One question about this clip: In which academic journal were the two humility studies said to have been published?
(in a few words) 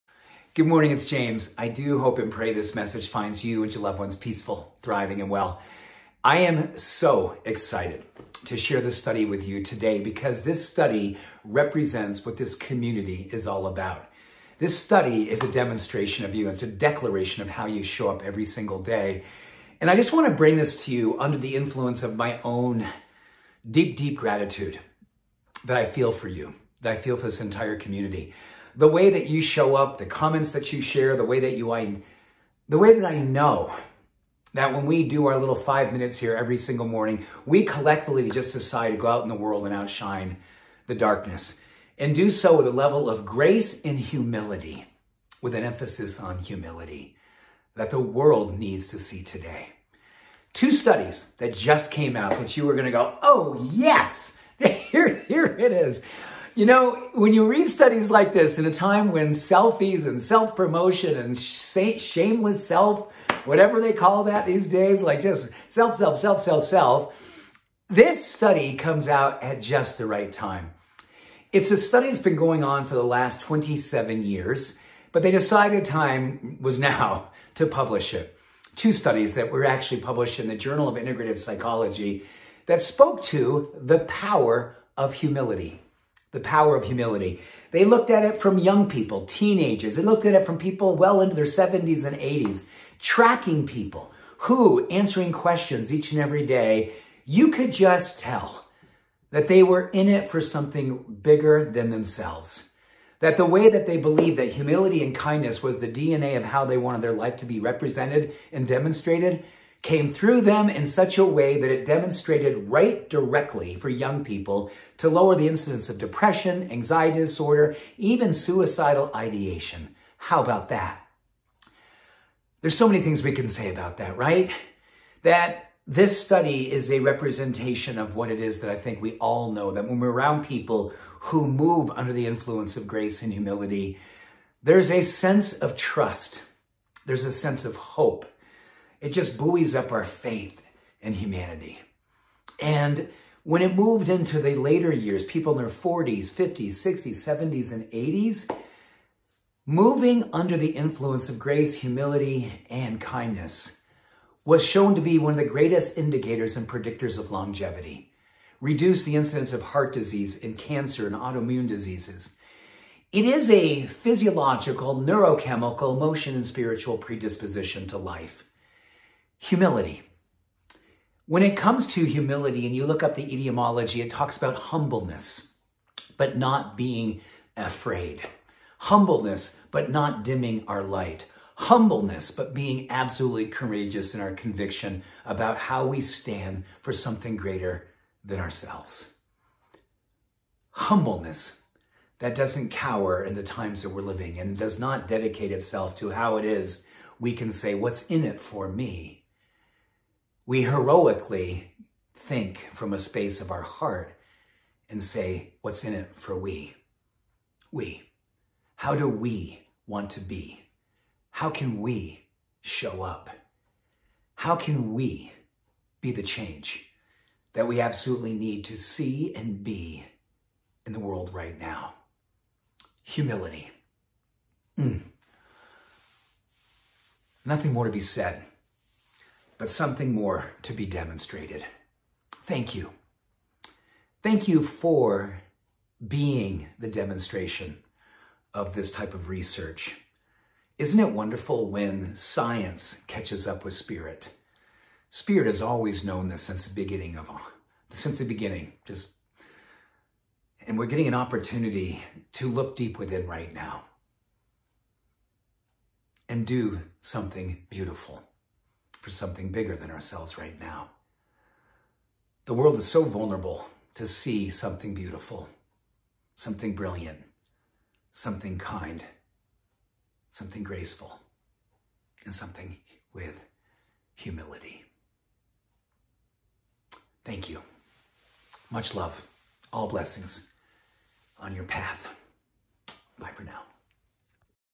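Journal of Integrative Psychology.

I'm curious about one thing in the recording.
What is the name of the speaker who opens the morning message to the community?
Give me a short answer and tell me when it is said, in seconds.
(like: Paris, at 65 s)
James, at 1 s.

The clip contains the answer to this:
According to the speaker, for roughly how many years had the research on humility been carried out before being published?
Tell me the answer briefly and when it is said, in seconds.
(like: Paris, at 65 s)
27 years, at 73 s.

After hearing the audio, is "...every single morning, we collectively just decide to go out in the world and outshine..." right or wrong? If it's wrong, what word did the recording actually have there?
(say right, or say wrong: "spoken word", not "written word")
right.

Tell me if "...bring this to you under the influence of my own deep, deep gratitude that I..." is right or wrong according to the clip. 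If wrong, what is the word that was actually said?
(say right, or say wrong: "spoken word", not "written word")
right.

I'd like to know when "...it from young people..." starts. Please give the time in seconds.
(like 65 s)
88 s.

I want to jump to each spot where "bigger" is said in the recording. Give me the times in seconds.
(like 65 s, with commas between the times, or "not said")
101 s, 259 s.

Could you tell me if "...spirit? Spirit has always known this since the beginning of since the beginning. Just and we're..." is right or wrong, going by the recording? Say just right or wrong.
right.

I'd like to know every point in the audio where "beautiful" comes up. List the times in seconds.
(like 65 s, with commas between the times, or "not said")
257 s, 264 s.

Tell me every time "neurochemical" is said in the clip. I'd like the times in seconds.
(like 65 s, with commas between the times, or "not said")
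164 s.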